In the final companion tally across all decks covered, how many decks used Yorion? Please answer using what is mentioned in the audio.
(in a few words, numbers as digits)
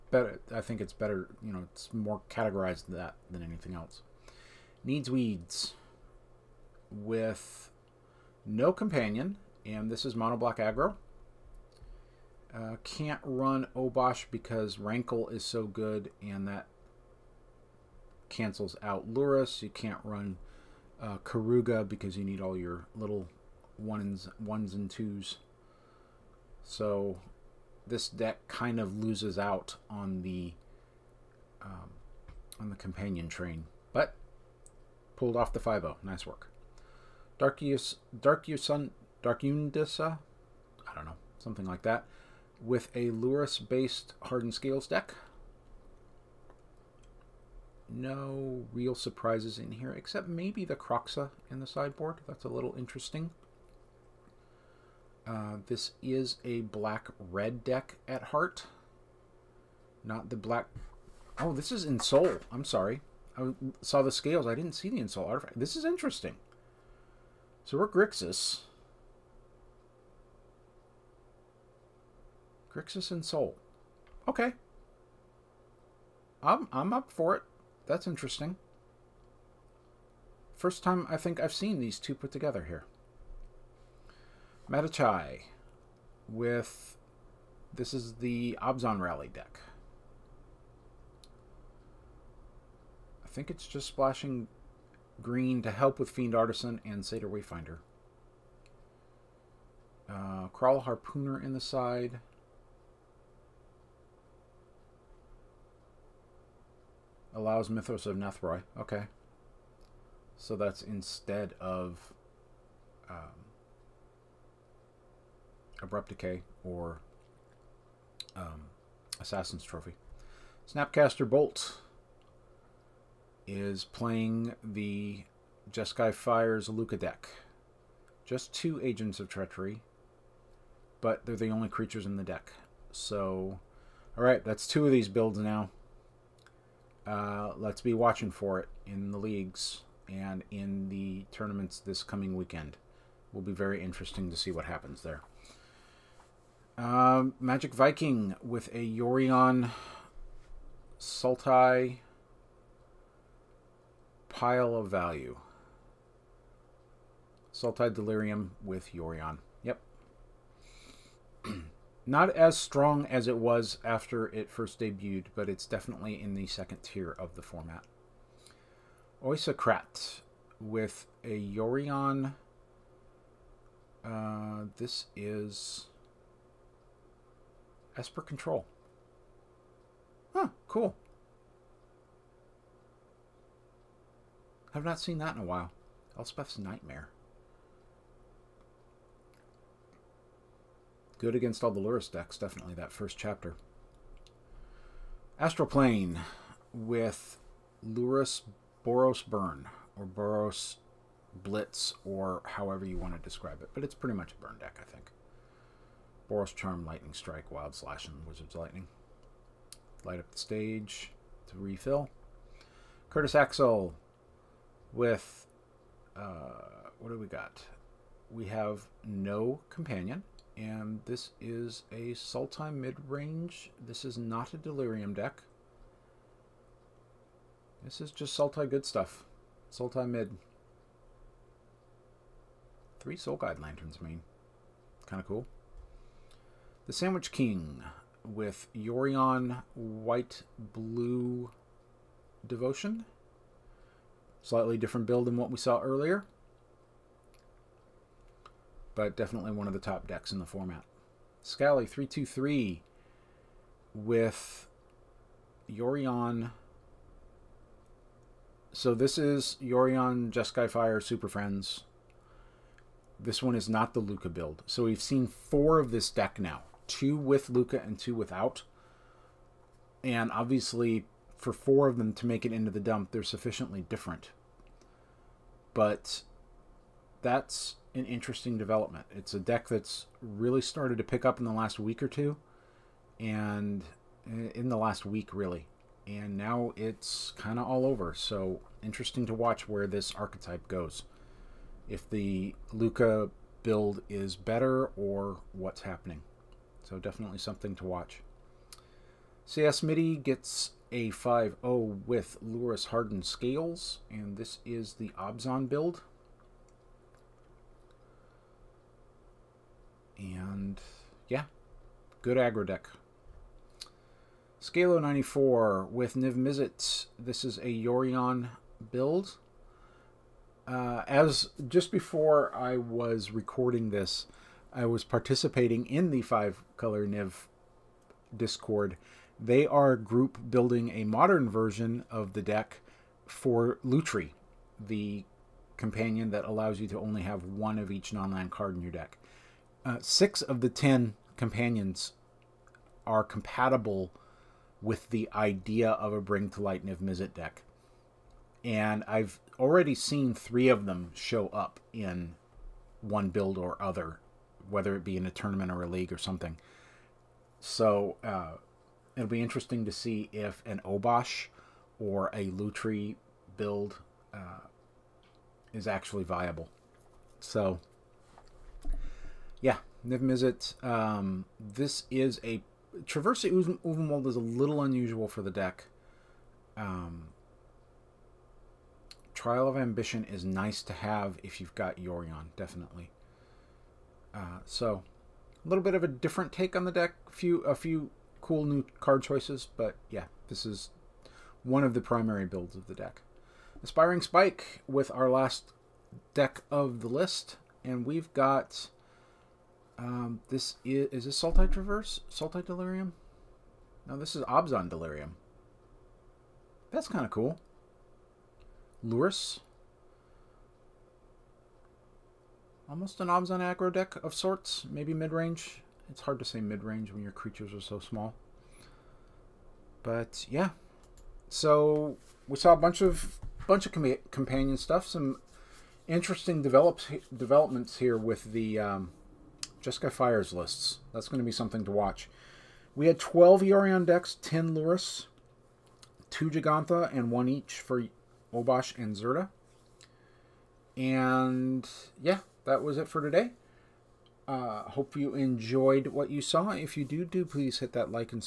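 12.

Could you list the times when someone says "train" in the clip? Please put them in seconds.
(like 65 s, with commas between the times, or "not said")
33 s.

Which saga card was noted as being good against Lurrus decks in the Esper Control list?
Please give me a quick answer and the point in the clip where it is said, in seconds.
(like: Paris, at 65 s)
Elspeth's Nightmare, at 186 s.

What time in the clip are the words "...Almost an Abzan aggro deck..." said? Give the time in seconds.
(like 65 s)
412 s.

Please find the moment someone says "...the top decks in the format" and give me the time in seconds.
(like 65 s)
249 s.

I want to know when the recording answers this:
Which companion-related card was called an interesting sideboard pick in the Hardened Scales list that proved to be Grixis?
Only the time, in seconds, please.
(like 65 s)
50 s.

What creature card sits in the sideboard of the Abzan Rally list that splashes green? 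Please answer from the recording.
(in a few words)
Kraul Harpooner.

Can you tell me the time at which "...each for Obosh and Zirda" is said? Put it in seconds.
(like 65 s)
437 s.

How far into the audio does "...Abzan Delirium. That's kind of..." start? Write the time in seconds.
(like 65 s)
404 s.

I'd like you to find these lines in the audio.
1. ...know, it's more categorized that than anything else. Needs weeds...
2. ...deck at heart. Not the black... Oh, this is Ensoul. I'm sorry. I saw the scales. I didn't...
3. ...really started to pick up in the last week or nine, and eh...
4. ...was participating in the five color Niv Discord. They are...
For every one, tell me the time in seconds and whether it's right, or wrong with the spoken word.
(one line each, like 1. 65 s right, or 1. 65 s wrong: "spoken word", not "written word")
1. 1 s right
2. 57 s right
3. 280 s wrong: "two", not "nine"
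4. 324 s right.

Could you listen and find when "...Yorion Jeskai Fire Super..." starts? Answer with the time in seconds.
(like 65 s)
259 s.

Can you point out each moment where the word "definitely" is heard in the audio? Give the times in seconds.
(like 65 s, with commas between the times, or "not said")
165 s, 192 s, 249 s, 296 s, 382 s.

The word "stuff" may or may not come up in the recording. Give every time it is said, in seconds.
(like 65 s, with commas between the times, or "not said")
228 s, 424 s.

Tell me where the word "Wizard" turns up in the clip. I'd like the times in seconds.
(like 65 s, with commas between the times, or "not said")
208 s.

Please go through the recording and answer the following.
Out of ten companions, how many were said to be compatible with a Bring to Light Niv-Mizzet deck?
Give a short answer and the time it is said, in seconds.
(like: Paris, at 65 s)
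6, at 339 s.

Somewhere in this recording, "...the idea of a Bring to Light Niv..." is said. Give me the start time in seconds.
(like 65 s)
345 s.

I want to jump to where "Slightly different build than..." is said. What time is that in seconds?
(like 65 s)
244 s.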